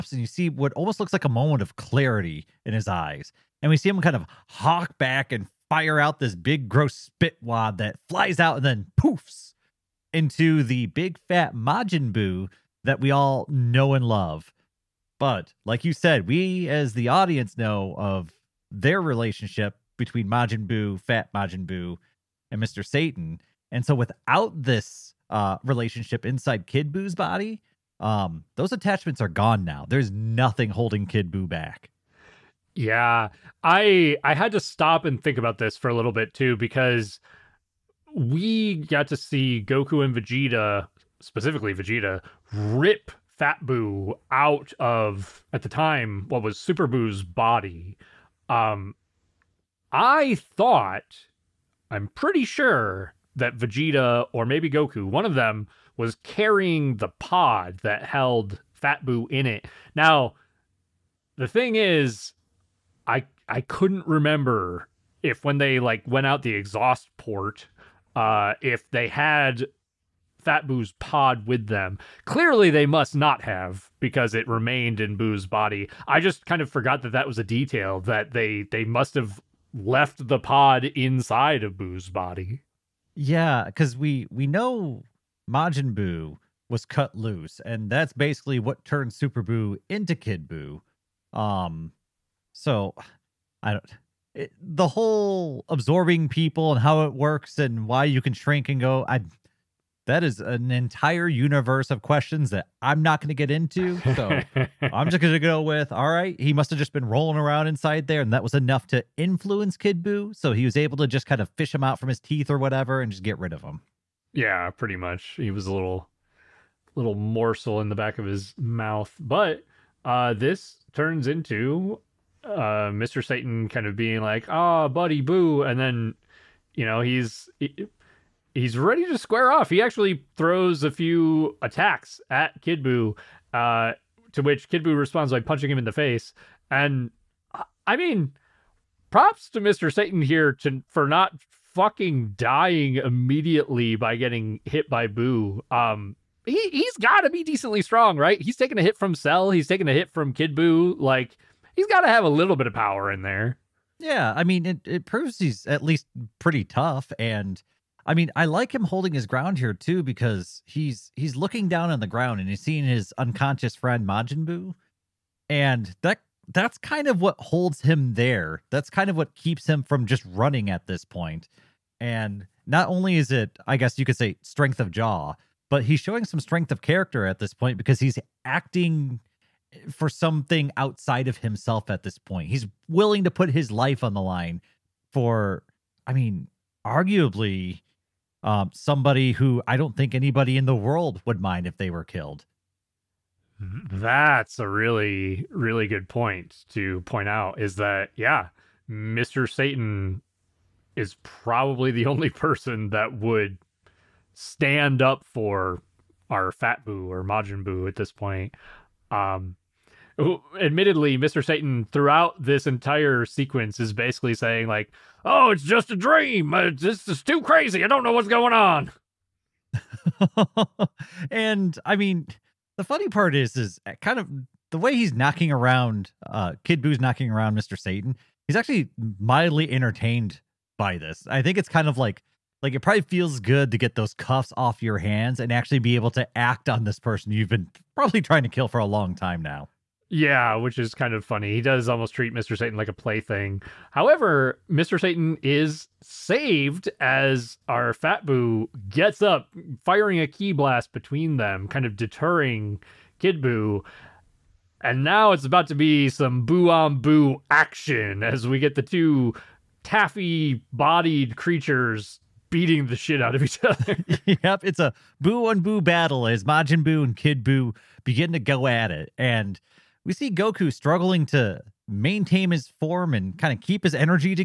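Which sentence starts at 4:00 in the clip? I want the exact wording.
Yeah, which is kind of funny.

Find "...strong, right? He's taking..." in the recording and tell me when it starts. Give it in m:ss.
2:27.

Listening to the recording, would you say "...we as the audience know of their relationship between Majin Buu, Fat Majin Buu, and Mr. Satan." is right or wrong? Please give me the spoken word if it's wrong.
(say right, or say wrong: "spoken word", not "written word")
right.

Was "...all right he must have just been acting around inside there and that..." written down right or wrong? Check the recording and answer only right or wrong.
wrong.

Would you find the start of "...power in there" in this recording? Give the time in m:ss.
2:32.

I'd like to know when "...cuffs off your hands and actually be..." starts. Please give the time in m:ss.
3:54.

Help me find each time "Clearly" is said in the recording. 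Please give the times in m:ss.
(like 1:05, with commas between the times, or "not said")
1:12.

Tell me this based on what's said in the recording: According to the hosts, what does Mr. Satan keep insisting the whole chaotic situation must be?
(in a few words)
a dream.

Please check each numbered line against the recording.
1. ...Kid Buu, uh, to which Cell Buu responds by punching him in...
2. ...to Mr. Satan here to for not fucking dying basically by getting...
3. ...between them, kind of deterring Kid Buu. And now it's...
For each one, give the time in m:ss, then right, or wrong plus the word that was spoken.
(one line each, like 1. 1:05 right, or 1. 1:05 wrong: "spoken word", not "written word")
1. 2:12 wrong: "Kid", not "Cell"
2. 2:19 wrong: "immediately", not "basically"
3. 4:10 right.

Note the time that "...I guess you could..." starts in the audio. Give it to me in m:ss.
2:53.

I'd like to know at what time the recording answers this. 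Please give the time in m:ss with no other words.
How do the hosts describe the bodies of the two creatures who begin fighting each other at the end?
4:19.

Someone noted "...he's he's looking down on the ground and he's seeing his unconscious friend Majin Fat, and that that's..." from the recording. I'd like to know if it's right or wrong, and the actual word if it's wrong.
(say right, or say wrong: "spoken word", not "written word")
wrong: "Buu", not "Fat".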